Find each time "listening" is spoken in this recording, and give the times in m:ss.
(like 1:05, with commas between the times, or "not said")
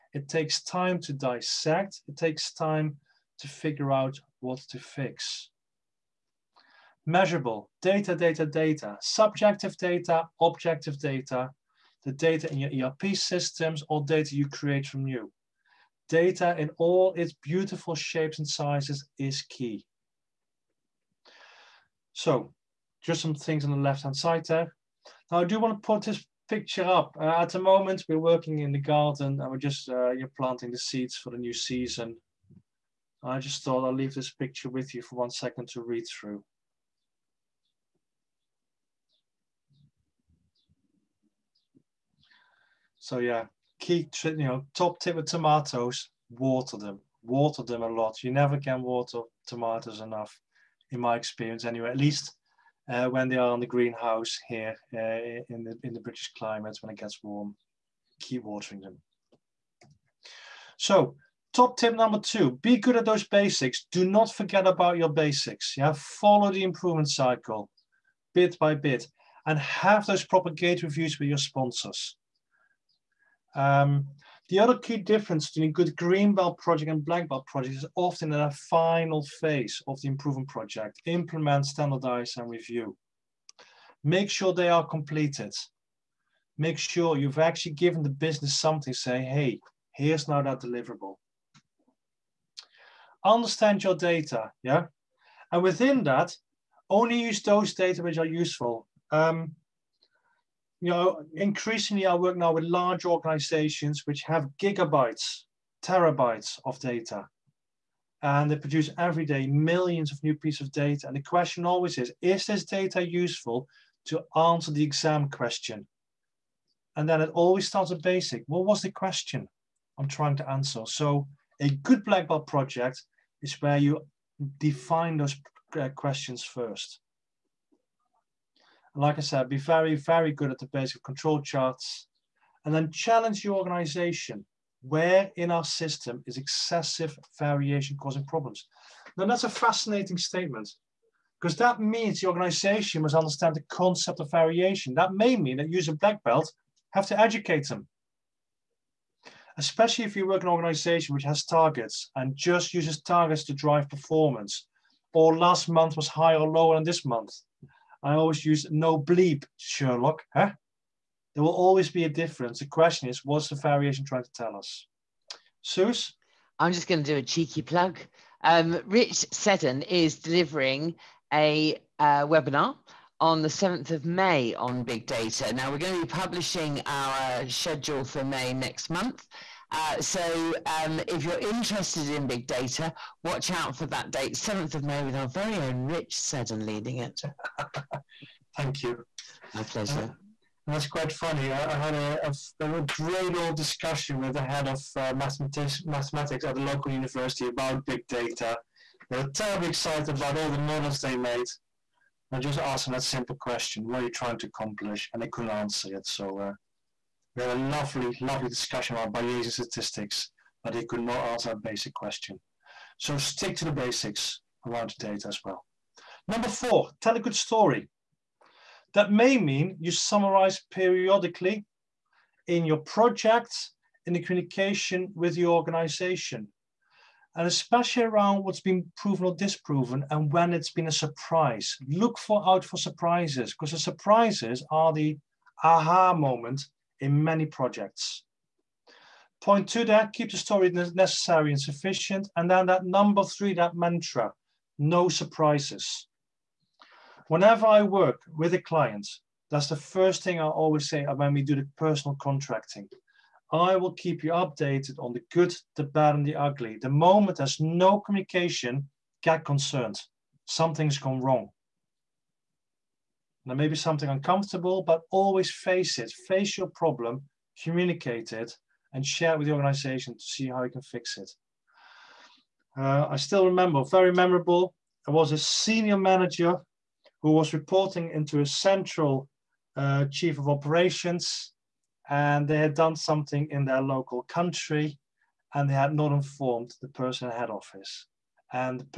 not said.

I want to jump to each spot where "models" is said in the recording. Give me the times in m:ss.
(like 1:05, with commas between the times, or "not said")
3:20.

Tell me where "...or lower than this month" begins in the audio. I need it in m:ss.
2:36.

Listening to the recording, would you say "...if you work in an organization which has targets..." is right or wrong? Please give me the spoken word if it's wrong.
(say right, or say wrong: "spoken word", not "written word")
right.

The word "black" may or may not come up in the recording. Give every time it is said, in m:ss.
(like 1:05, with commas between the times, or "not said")
1:17, 2:02, 2:25.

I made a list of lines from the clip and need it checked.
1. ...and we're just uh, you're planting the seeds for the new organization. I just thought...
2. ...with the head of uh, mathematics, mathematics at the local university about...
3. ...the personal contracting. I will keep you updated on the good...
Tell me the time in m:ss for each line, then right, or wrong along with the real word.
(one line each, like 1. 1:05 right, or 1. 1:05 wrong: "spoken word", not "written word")
1. 0:29 wrong: "season", not "organization"
2. 3:14 right
3. 4:11 right.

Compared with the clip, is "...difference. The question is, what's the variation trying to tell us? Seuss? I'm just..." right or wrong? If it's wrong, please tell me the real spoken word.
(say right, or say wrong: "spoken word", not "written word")
right.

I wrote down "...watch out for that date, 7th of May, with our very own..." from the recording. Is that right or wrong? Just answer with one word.
right.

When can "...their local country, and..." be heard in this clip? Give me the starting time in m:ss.
4:43.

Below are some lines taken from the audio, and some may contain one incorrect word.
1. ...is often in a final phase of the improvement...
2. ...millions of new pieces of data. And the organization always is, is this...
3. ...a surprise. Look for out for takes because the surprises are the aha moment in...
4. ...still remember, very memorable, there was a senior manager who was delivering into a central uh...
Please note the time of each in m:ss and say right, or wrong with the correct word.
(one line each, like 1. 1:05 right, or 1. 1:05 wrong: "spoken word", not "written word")
1. 1:17 right
2. 1:49 wrong: "question", not "organization"
3. 3:50 wrong: "surprises", not "takes"
4. 4:33 wrong: "reporting", not "delivering".